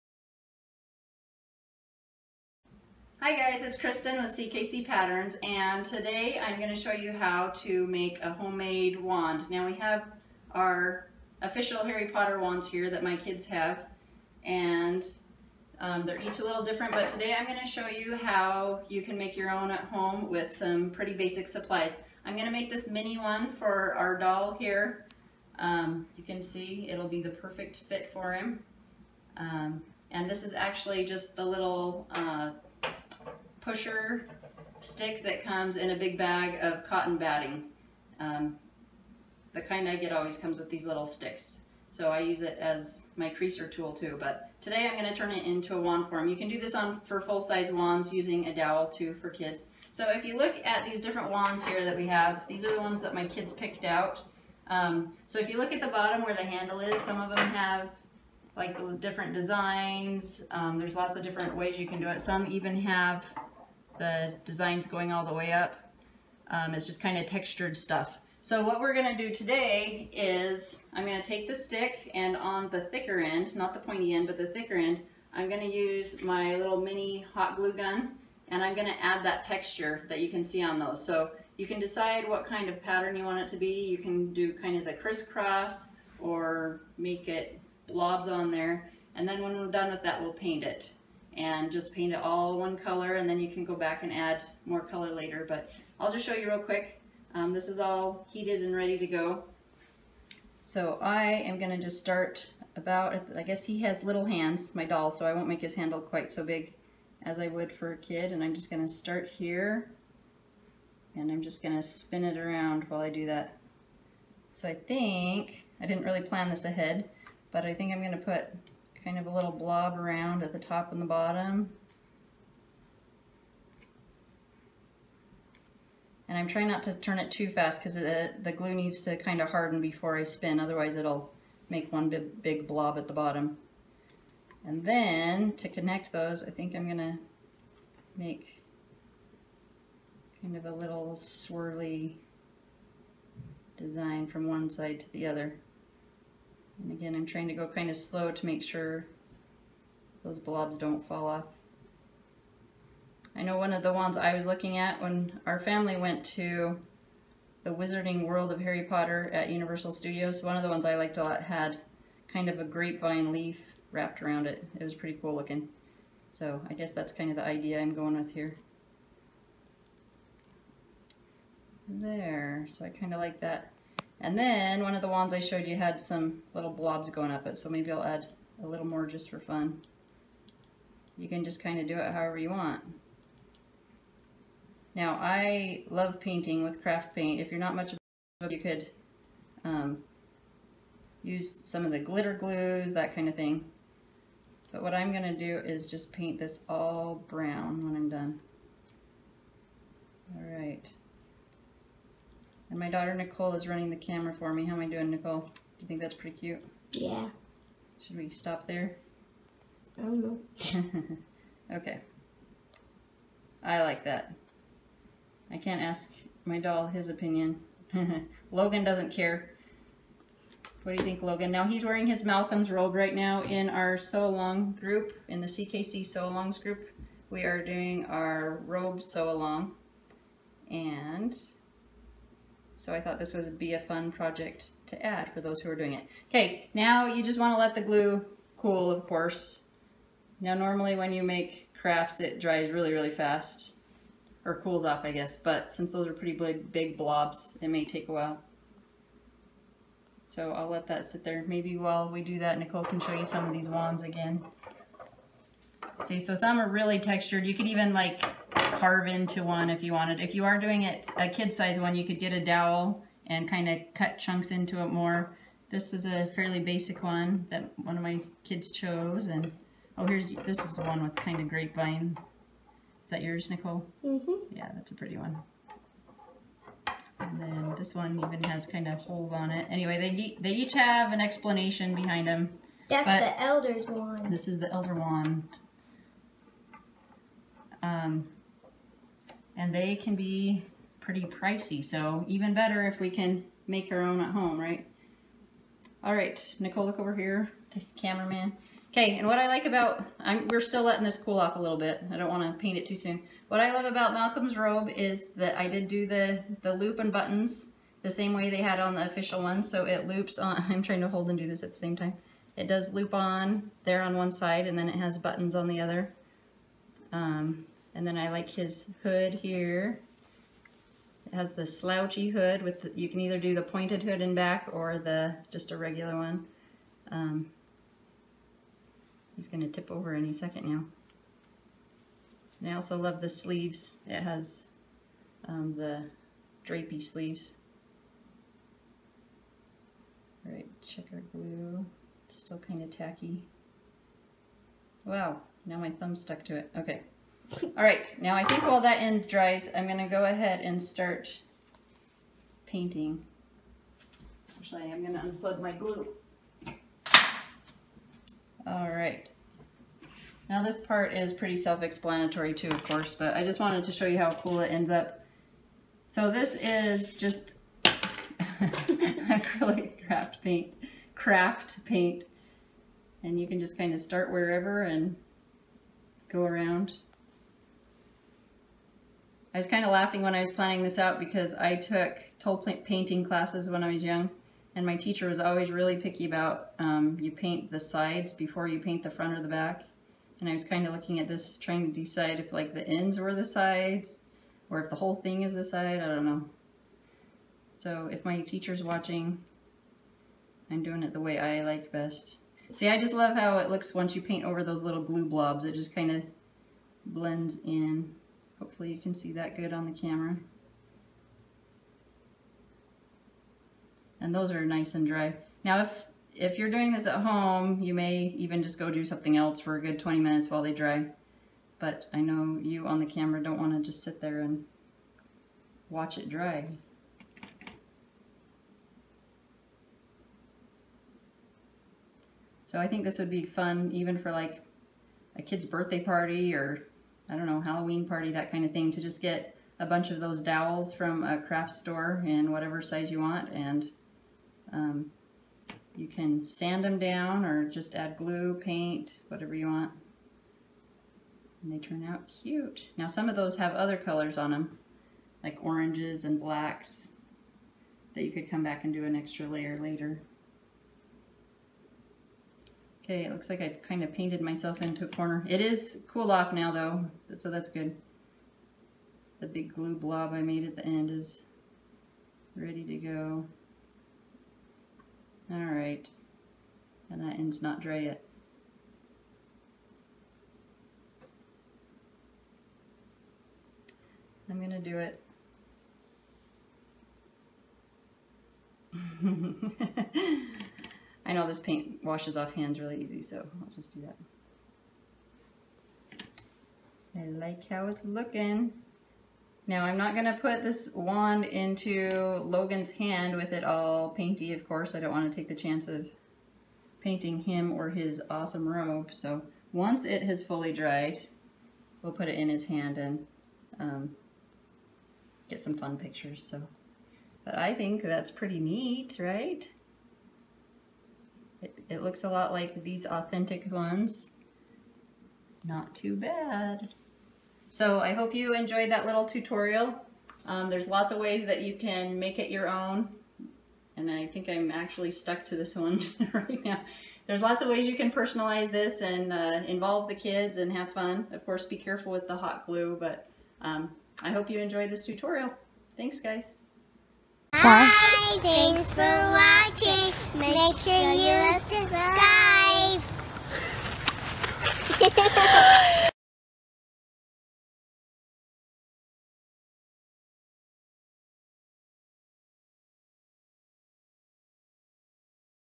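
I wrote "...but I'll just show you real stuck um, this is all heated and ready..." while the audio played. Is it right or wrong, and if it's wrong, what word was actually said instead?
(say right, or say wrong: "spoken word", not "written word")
wrong: "quick", not "stuck".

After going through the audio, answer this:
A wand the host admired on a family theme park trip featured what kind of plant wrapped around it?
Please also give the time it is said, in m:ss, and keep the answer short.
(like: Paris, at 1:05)
grapevine leaf, at 2:42.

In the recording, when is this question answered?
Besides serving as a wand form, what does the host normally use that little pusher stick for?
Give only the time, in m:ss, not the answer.
0:43.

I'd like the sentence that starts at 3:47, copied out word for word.
We are doing our robe sew along.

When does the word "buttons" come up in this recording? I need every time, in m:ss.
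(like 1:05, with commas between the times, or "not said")
5:07, 5:15.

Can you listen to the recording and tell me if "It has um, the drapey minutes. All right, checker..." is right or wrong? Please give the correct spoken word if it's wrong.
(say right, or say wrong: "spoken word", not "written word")
wrong: "sleeves", not "minutes".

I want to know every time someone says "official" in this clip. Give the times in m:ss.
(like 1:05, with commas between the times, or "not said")
0:11, 5:09.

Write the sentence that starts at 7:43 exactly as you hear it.
Okay, it looks like I've kind of painted myself into a corner.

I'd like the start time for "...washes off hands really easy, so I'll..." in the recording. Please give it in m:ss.
8:12.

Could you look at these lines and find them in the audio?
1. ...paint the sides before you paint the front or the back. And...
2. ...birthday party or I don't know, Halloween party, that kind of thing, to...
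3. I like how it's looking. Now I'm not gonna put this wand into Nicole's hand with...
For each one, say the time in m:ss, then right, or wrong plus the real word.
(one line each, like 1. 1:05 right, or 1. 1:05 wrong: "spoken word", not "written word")
1. 6:27 right
2. 7:15 right
3. 8:17 wrong: "Logan", not "Nicole".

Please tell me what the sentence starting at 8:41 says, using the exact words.
It, it looks a lot like these authentic ones.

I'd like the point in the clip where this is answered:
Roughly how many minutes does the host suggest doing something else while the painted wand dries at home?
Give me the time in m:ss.
6:59.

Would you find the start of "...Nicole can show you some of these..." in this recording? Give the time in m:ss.
4:12.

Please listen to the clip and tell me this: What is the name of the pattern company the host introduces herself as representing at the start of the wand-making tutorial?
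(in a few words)
CKC Patterns.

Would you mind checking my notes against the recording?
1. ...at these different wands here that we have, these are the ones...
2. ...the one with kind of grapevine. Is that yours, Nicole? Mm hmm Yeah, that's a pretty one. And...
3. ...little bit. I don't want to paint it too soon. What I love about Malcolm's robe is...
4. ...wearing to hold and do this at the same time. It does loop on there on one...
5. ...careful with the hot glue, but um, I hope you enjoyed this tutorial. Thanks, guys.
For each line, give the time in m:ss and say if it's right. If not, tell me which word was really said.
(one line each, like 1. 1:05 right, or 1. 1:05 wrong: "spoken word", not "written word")
1. 0:50 right
2. 4:30 right
3. 5:01 right
4. 5:10 wrong: "trying", not "wearing"
5. 9:01 right.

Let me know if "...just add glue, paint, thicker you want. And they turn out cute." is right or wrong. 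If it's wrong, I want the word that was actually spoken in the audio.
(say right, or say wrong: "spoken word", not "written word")
wrong: "whatever", not "thicker".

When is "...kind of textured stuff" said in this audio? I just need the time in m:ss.
1:06.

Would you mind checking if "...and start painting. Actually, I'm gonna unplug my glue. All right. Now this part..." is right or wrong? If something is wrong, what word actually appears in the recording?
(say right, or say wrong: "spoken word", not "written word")
right.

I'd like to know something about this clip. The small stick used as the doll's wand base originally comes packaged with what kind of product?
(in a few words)
cotton batting.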